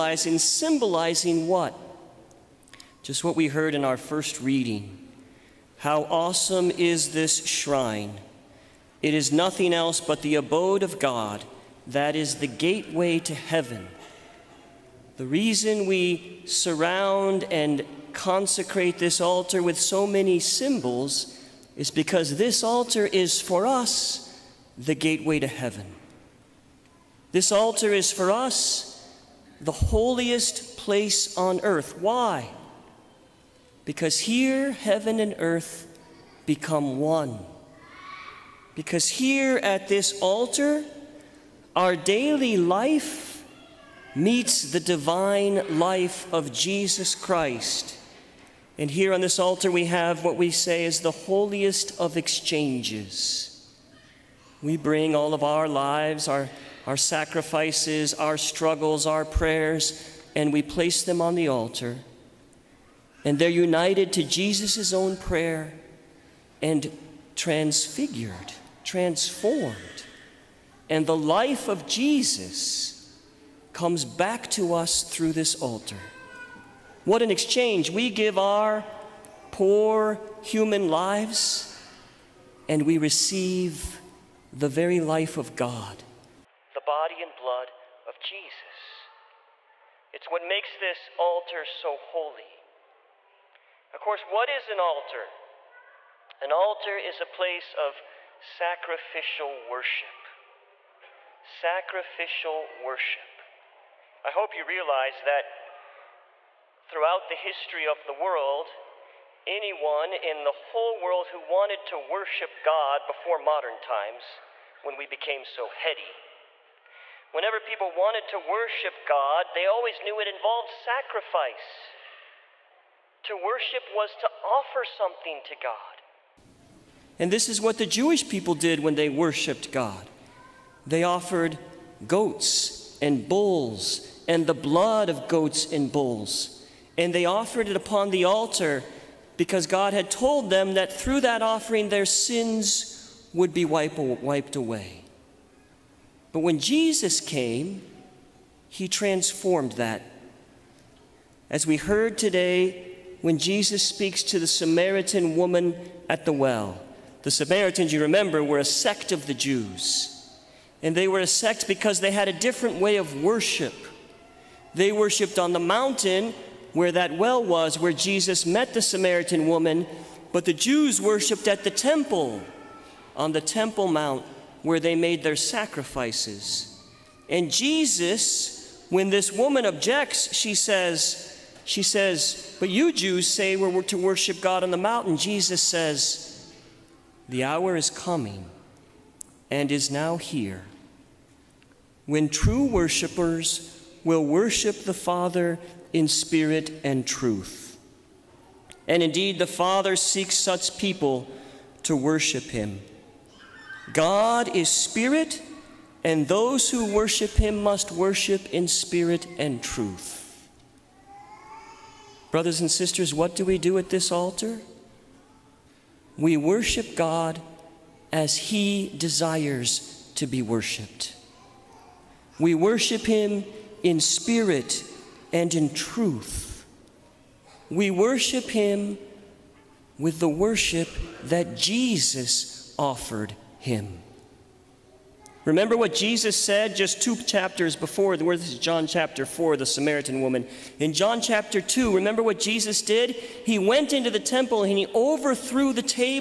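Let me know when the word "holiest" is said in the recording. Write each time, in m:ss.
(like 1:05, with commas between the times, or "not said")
0:29, 0:51.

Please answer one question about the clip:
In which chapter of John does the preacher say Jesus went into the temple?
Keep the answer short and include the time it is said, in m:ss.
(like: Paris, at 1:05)
Chapter 2, at 4:00.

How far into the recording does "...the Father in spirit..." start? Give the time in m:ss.
3:14.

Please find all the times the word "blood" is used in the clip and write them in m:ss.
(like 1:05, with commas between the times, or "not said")
1:27, 2:14.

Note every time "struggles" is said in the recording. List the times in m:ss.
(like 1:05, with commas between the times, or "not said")
0:58.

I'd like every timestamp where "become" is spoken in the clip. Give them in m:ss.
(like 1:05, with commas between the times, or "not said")
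0:36.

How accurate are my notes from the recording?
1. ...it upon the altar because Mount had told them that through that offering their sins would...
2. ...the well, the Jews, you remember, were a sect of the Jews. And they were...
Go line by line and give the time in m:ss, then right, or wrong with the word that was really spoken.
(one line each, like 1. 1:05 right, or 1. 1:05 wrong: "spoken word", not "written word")
1. 2:17 wrong: "God", not "Mount"
2. 2:36 wrong: "Samaritans", not "Jews".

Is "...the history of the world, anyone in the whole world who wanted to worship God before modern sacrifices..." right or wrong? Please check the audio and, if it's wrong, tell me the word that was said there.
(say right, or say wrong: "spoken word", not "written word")
wrong: "times", not "sacrifices".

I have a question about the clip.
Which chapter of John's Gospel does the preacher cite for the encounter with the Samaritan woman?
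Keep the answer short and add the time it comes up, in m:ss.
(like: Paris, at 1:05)
Chapter 4, at 3:58.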